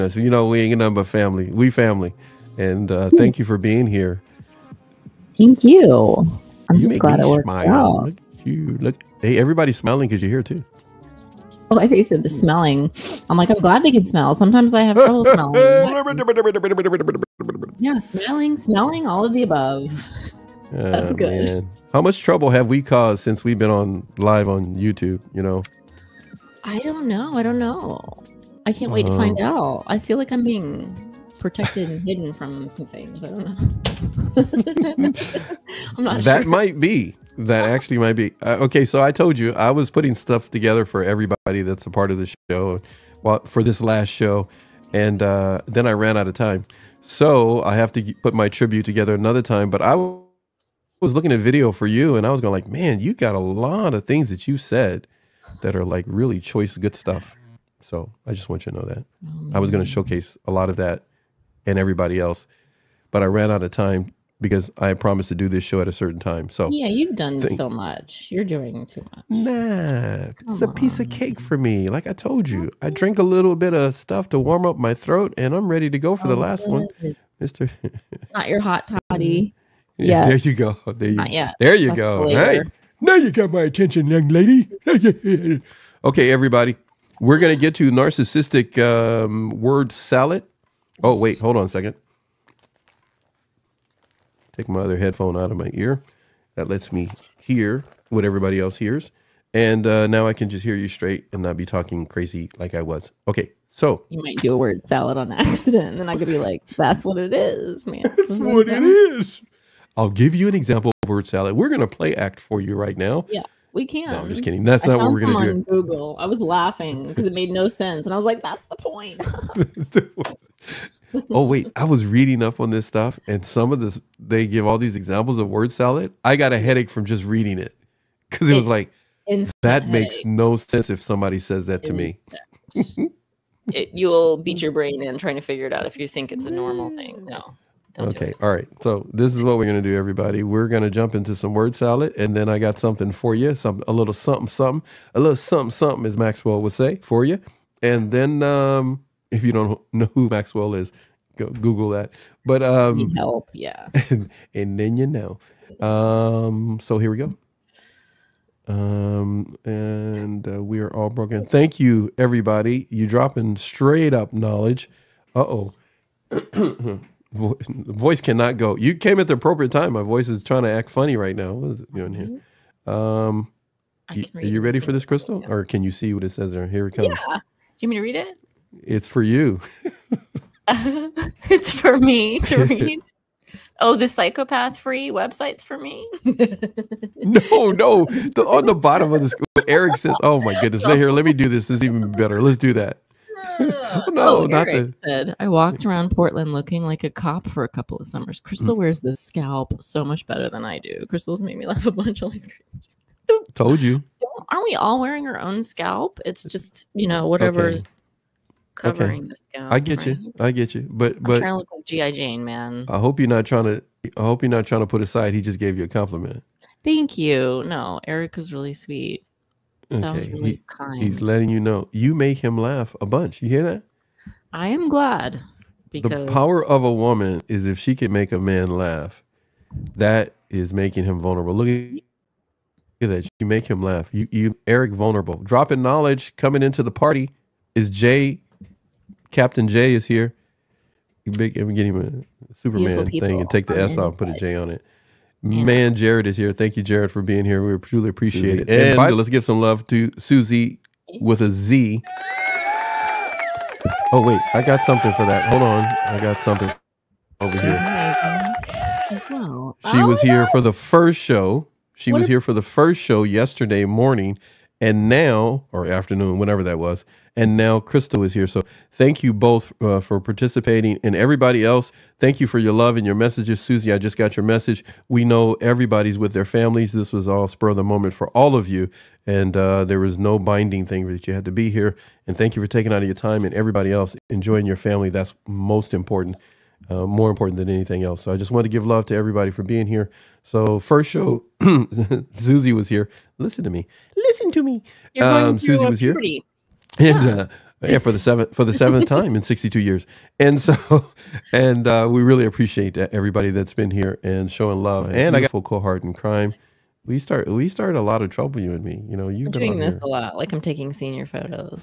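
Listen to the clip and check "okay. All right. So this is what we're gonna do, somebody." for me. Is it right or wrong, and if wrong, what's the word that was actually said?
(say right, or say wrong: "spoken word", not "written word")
wrong: "everybody", not "somebody".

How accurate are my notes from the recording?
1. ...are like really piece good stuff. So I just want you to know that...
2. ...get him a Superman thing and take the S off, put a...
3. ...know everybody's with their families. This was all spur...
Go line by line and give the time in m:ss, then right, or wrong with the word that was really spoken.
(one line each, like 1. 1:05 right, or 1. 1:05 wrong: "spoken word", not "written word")
1. 0:55 wrong: "choice", not "piece"
2. 4:01 right
3. 4:35 right.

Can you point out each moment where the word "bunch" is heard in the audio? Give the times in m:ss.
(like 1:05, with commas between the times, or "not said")
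3:21, 3:43.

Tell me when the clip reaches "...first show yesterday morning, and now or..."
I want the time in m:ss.
4:22.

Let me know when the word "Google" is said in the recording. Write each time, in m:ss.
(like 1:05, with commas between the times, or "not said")
1:55, 2:31.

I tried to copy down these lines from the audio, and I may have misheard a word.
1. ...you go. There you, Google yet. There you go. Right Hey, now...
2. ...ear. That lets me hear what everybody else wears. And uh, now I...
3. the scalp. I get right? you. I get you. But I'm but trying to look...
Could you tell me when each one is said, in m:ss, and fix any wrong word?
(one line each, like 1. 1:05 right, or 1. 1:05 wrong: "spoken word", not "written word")
1. 1:20 wrong: "Not", not "Google"
2. 1:35 wrong: "hears", not "wears"
3. 3:29 right.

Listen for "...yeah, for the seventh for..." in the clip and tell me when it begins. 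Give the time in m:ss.
4:57.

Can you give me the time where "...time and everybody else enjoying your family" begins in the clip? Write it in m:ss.
4:43.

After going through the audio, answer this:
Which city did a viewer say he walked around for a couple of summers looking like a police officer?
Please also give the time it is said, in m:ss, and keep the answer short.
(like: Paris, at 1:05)
Portland, at 3:16.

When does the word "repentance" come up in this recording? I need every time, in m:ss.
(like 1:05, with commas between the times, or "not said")
not said.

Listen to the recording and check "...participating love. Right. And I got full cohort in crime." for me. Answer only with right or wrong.
wrong.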